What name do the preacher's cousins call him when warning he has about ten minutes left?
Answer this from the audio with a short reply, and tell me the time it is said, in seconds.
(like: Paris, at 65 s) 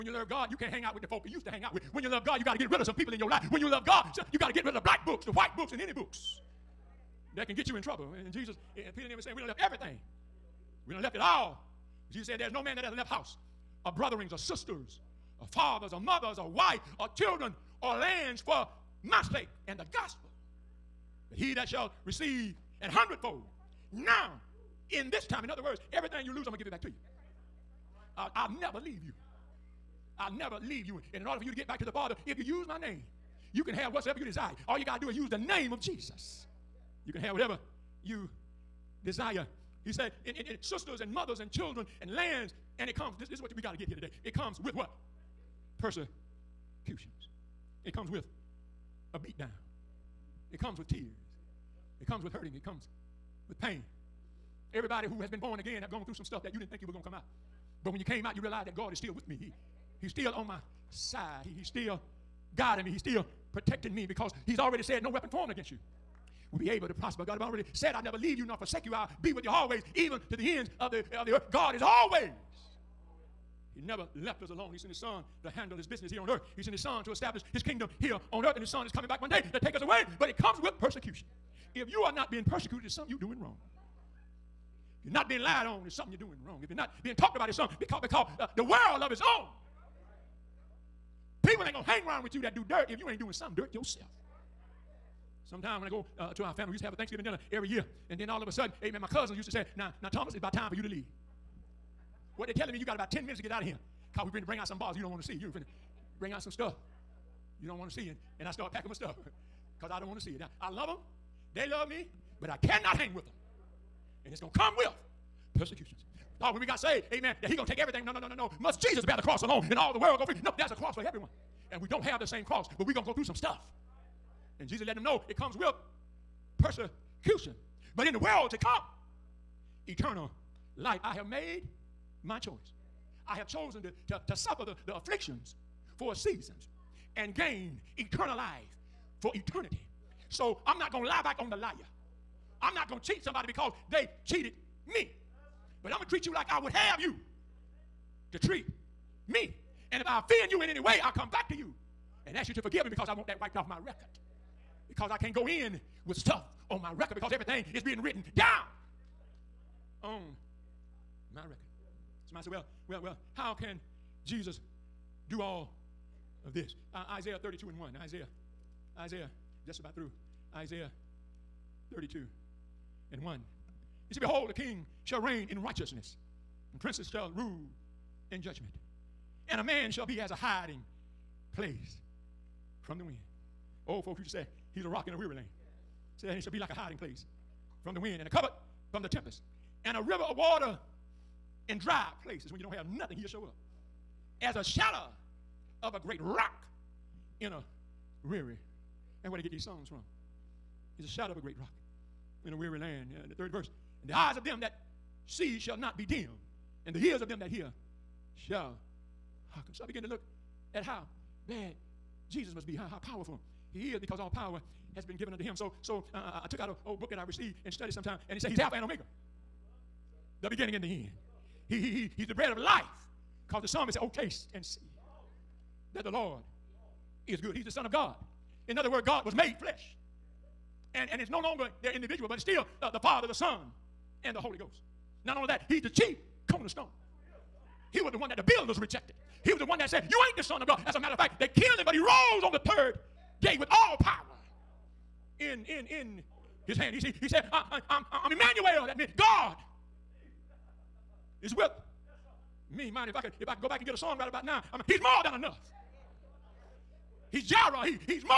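Thomas, at 100 s.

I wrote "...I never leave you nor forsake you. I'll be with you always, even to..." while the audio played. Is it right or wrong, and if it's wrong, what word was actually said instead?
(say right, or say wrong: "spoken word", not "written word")
right.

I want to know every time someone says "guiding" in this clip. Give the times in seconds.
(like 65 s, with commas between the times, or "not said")
62 s.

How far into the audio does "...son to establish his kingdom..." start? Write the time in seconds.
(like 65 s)
76 s.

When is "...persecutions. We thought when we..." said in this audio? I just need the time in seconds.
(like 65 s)
115 s.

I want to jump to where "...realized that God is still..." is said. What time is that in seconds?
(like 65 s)
58 s.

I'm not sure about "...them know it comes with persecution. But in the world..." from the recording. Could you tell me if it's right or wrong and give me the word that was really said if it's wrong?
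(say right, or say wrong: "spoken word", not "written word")
right.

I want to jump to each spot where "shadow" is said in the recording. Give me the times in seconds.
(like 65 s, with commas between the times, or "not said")
194 s, 201 s.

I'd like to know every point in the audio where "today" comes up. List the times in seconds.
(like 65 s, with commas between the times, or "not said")
43 s.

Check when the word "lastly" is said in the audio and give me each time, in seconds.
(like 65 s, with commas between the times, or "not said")
not said.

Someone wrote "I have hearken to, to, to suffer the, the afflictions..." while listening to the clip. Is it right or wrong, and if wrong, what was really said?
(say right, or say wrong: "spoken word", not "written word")
wrong: "chosen", not "hearken".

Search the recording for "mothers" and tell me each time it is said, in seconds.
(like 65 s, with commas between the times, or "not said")
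15 s, 41 s.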